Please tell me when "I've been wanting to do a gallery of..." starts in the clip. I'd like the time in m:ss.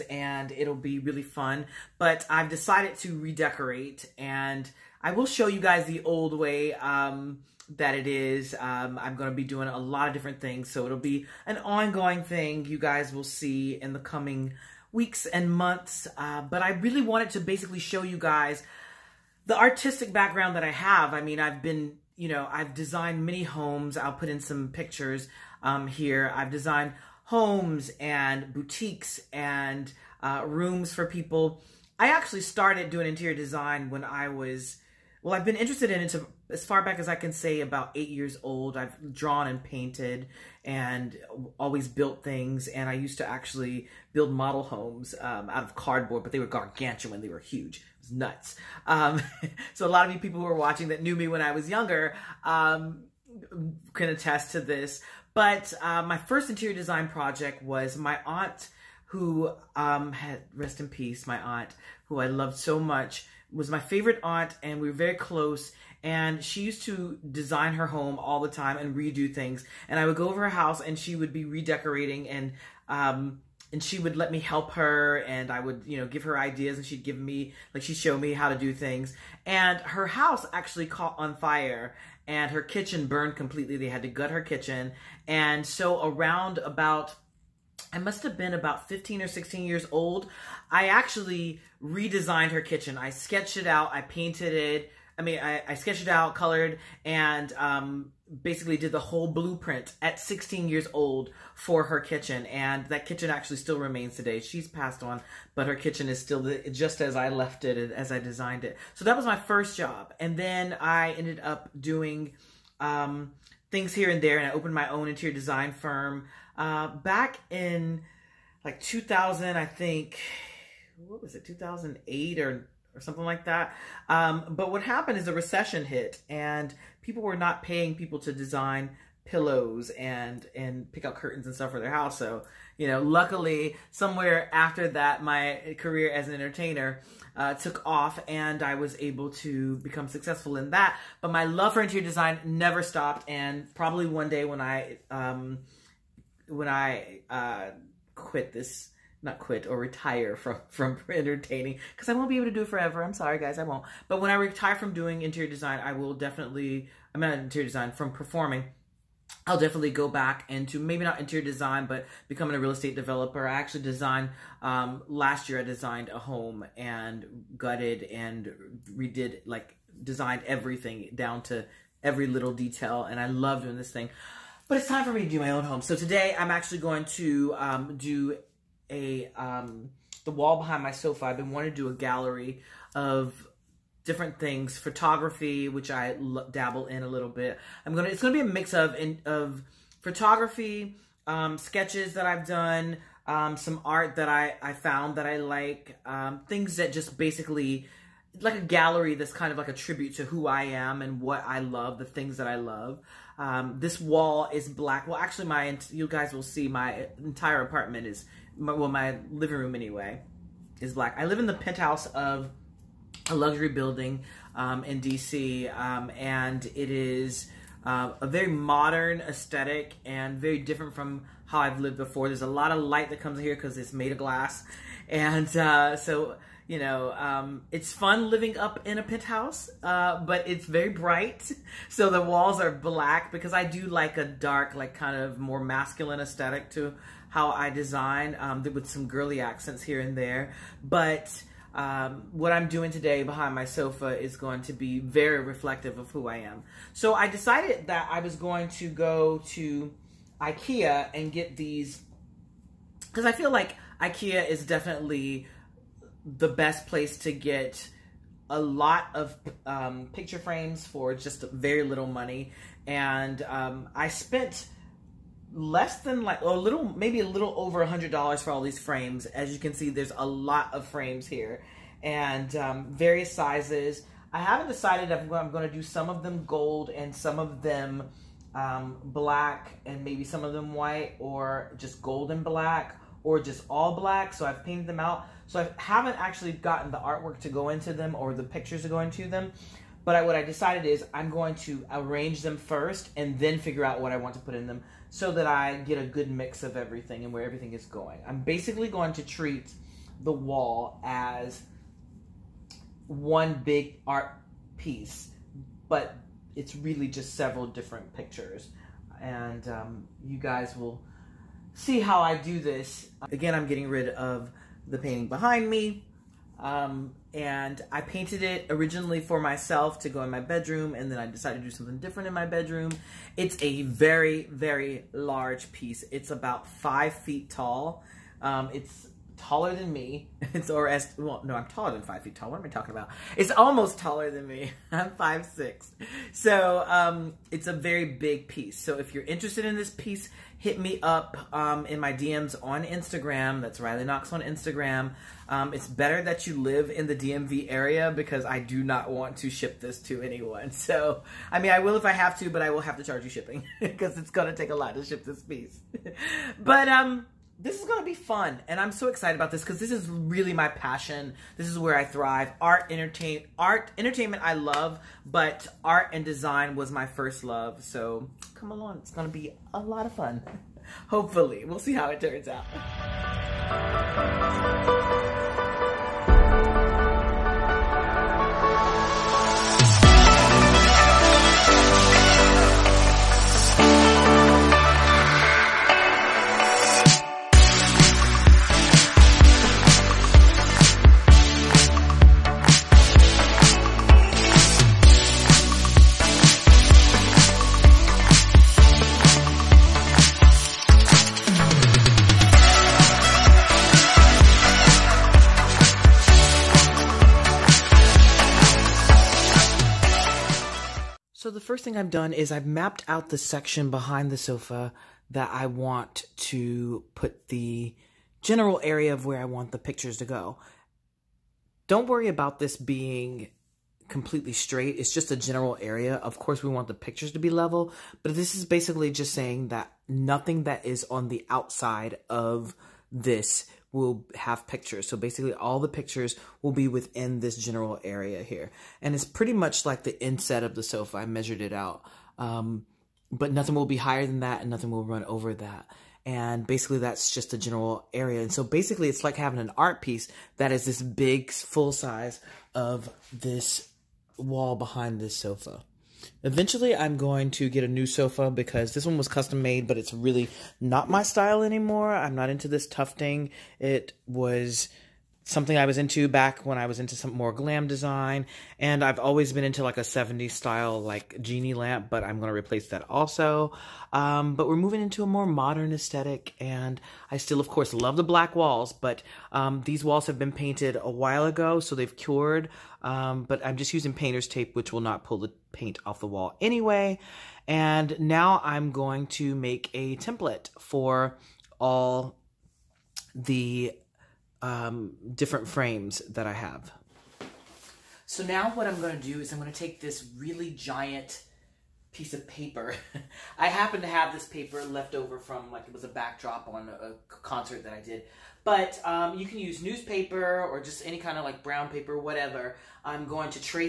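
3:01.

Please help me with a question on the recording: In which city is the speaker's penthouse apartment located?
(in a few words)
DC.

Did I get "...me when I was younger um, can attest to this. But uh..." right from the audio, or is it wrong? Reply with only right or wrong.
right.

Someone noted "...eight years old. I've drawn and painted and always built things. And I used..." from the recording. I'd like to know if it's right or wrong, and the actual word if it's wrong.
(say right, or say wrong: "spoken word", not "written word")
right.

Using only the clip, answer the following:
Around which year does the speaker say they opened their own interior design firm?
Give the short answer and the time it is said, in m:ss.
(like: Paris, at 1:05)
2008, at 2:01.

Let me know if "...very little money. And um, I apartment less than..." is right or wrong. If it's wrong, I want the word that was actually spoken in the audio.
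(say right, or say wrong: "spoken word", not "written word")
wrong: "spent", not "apartment".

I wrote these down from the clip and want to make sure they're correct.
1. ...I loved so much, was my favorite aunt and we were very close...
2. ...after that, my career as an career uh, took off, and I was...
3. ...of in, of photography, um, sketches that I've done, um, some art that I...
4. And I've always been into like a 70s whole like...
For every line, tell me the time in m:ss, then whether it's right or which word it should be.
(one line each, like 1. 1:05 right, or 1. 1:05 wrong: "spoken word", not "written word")
1. 1:02 right
2. 2:14 wrong: "entertainer", not "career"
3. 3:08 right
4. 7:48 wrong: "style", not "whole".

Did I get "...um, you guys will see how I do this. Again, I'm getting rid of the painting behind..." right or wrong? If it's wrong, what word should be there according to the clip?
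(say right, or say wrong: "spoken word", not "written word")
right.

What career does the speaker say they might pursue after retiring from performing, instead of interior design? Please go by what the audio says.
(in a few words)
Real estate developer.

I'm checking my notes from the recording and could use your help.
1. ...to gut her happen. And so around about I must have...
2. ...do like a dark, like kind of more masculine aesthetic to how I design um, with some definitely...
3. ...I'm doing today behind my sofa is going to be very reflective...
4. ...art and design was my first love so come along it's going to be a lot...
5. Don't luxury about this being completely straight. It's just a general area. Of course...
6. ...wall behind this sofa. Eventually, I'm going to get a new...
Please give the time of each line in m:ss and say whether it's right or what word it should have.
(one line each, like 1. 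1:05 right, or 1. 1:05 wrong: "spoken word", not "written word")
1. 1:24 wrong: "kitchen", not "happen"
2. 3:53 wrong: "girly", not "definitely"
3. 4:02 right
4. 6:05 right
5. 7:01 wrong: "worry", not "luxury"
6. 7:34 right.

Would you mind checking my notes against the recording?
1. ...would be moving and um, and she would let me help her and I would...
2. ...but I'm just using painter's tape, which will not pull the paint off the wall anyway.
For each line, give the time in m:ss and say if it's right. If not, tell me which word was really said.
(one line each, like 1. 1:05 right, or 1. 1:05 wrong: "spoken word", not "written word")
1. 1:11 wrong: "redecorating", not "moving"
2. 8:03 right.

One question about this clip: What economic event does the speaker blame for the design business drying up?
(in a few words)
A recession.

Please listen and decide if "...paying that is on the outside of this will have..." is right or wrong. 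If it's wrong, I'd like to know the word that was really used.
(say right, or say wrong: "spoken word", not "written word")
wrong: "nothing", not "paying".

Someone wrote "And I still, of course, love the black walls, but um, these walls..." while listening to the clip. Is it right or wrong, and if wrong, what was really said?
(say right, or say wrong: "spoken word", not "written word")
right.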